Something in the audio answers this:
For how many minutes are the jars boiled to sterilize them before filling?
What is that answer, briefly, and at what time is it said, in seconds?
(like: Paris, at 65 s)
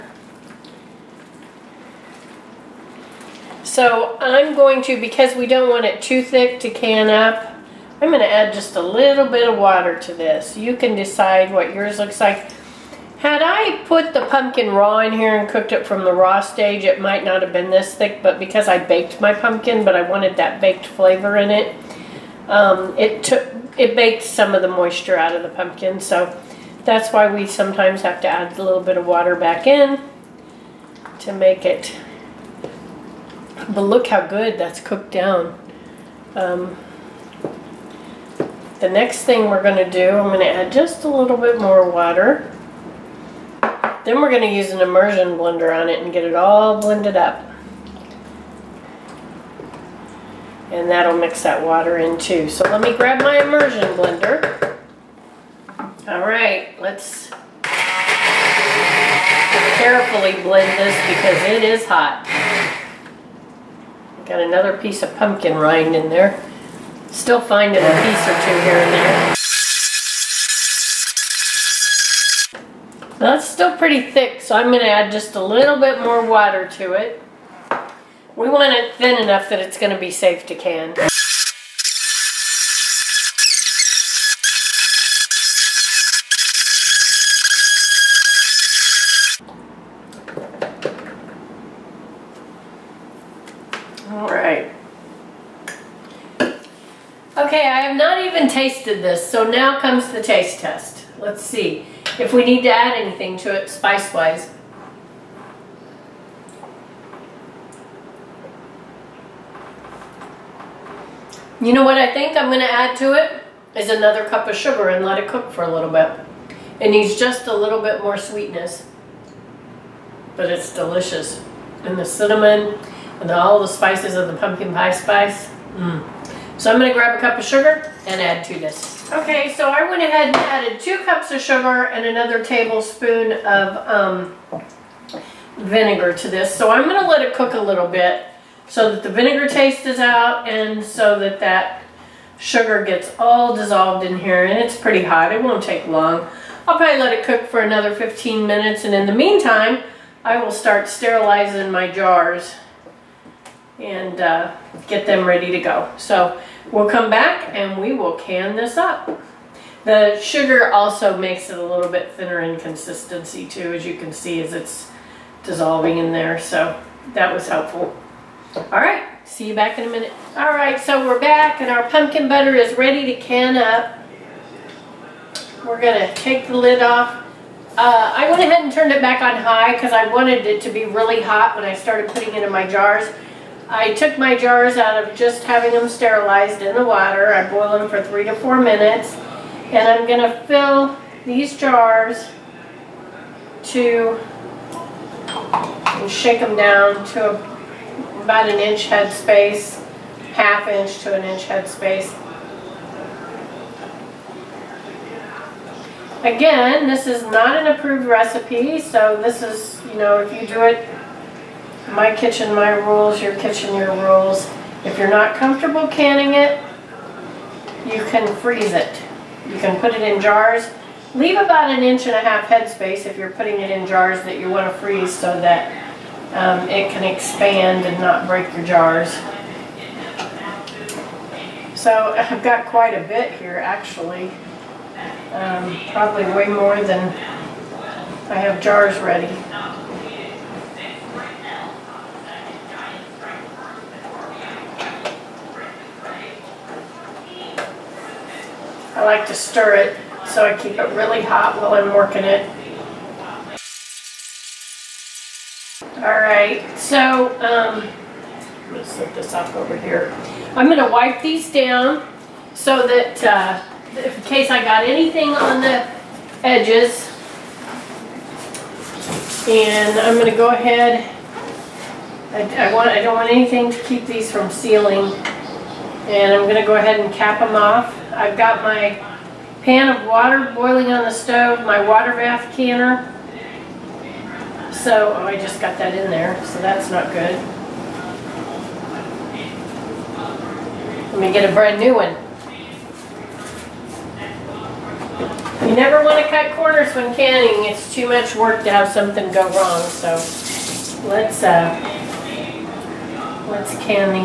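3 to 4 minutes, at 188 s.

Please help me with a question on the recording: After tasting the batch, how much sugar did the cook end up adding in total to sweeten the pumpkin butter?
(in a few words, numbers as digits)
2 cups.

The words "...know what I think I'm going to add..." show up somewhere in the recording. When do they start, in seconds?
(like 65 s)
111 s.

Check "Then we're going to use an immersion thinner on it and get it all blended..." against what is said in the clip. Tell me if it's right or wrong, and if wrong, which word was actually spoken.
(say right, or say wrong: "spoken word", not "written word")
wrong: "blender", not "thinner".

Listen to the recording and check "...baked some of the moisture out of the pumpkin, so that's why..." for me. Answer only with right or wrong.
right.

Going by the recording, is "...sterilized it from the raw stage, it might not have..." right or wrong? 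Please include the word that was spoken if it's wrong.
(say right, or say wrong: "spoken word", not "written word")
wrong: "cooked", not "sterilized".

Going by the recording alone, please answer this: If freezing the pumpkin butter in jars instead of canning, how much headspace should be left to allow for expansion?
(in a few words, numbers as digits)
1.5 inches.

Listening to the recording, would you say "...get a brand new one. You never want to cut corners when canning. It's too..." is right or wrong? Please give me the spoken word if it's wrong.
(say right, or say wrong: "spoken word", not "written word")
right.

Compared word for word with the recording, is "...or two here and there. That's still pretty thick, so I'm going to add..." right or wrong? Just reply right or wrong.
right.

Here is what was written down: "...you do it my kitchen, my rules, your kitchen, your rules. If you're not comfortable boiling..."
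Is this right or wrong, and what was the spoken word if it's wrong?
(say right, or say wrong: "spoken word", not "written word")
wrong: "canning", not "boiling".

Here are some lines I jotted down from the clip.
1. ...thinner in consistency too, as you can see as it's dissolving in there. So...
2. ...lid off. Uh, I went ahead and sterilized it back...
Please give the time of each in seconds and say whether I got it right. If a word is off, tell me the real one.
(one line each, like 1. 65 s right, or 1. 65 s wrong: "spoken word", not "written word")
1. 162 s right
2. 176 s wrong: "turned", not "sterilized".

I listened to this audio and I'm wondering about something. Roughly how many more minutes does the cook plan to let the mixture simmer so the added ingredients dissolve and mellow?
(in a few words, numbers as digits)
15 minutes.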